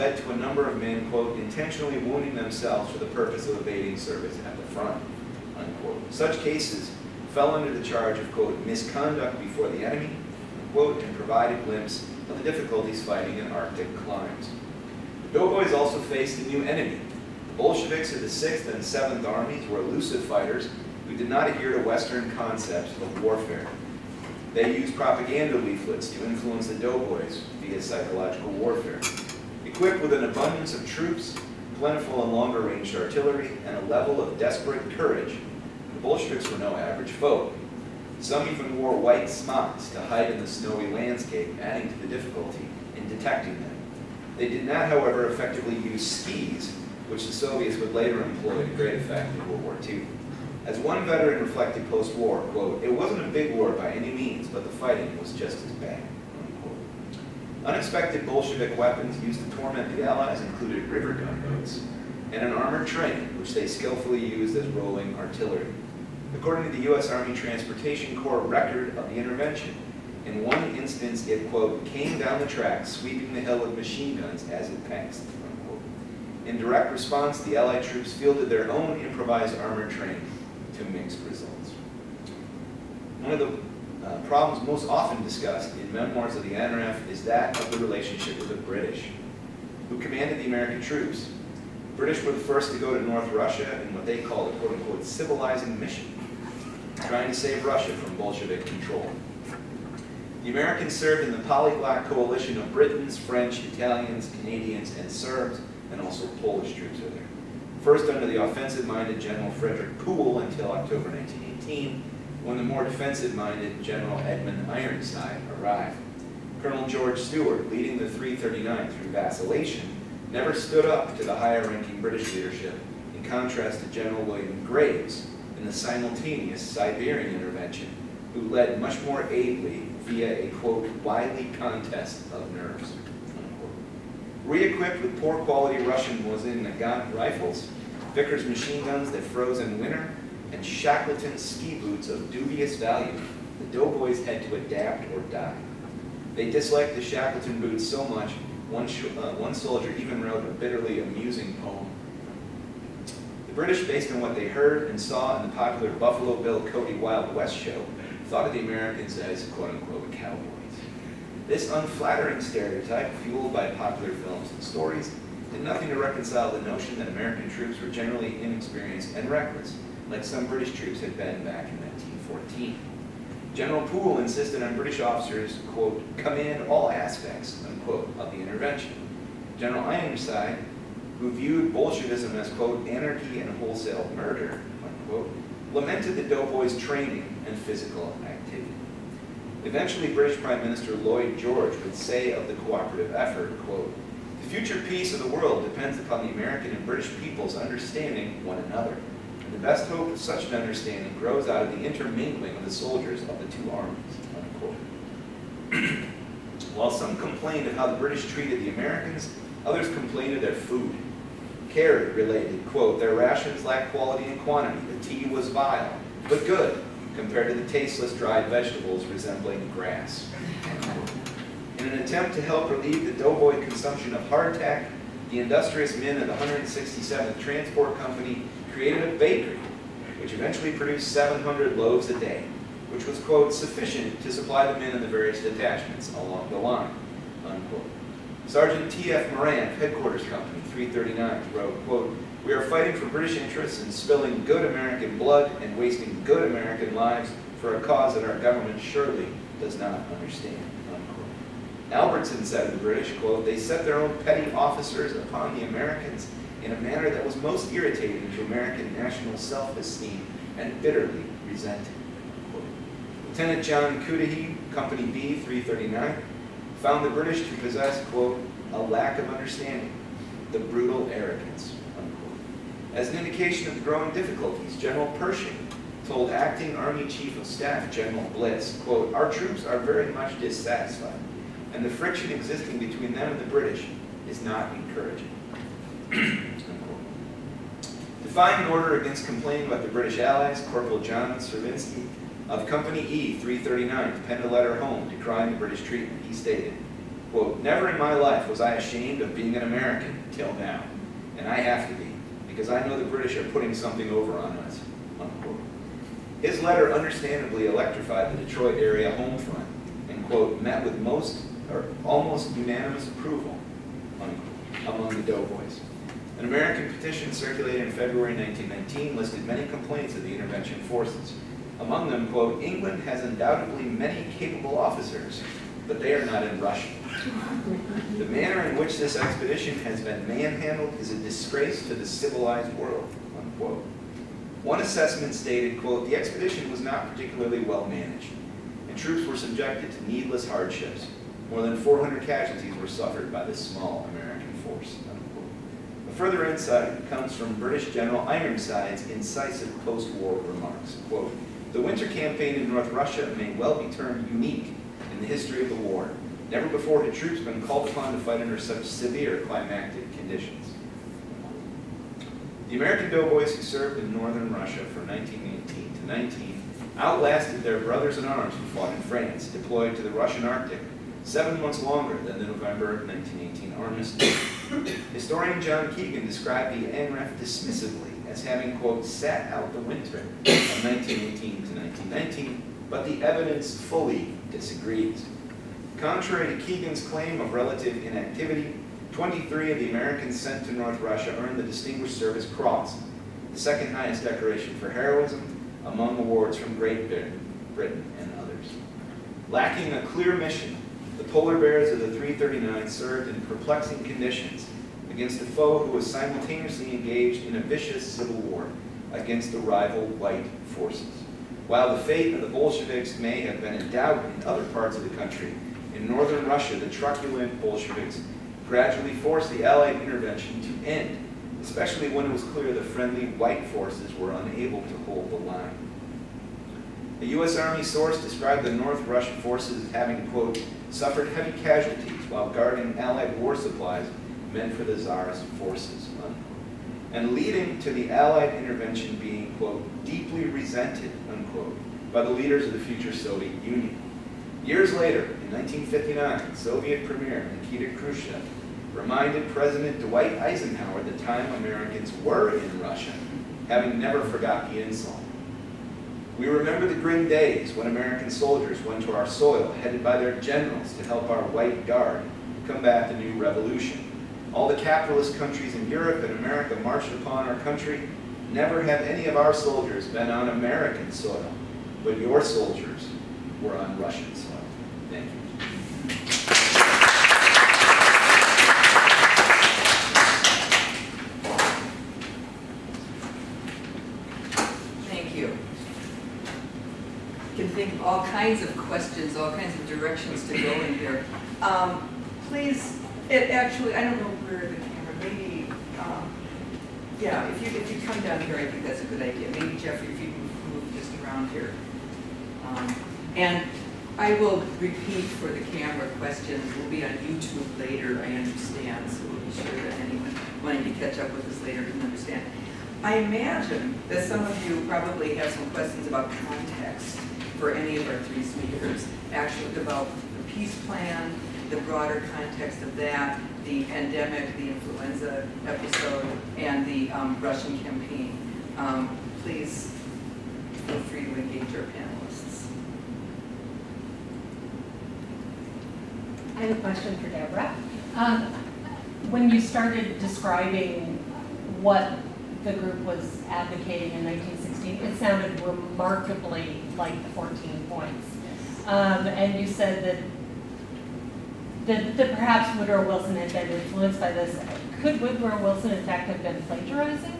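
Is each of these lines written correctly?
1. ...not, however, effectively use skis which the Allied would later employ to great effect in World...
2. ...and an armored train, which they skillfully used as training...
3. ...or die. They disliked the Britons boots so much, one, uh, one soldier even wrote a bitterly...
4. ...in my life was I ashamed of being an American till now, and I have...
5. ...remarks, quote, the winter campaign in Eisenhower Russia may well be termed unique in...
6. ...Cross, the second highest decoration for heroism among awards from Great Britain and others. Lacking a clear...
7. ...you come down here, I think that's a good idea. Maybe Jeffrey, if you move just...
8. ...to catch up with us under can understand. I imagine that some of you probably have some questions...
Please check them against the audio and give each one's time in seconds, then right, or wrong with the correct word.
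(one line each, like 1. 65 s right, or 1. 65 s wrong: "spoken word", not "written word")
1. 44 s wrong: "Soviets", not "Allied"
2. 62 s wrong: "rolling", not "training"
3. 145 s wrong: "Shackleton", not "Britons"
4. 297 s right
5. 350 s wrong: "North", not "Eisenhower"
6. 392 s right
7. 497 s right
8. 510 s wrong: "later", not "under".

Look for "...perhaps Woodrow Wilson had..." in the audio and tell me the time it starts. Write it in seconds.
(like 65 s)
552 s.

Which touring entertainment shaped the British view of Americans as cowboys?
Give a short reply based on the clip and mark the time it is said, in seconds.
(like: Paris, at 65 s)
Buffalo Bill Cody Wild West show, at 155 s.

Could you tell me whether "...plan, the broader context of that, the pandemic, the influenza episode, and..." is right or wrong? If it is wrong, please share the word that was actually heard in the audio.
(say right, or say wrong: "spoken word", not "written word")
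right.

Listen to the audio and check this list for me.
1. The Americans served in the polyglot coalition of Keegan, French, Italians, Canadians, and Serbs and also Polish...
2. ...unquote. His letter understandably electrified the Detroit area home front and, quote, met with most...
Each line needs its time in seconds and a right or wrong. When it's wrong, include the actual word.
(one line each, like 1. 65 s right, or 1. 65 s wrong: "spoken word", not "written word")
1. 100 s wrong: "Britons", not "Keegan"
2. 305 s right.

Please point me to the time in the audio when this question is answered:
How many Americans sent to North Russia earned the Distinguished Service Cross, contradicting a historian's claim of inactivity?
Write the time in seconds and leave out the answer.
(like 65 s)
389 s.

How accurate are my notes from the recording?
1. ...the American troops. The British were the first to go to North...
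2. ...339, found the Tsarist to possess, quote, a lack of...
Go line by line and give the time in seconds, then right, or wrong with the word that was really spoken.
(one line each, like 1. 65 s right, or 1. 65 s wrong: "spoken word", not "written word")
1. 90 s right
2. 265 s wrong: "British", not "Tsarist".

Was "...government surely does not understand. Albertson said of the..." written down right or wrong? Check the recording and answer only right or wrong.
right.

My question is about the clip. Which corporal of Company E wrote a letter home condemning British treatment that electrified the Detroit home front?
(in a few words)
John Servinsky.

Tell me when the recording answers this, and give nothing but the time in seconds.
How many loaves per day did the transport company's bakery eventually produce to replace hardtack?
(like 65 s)
231 s.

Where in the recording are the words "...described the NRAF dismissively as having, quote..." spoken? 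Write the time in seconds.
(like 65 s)
376 s.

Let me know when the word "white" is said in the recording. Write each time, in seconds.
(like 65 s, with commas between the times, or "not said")
38 s, 410 s, 423 s, 461 s.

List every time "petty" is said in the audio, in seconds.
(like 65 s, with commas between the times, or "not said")
254 s.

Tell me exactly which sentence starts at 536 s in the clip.
I have a question for Deborah.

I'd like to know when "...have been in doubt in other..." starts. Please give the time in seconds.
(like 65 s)
413 s.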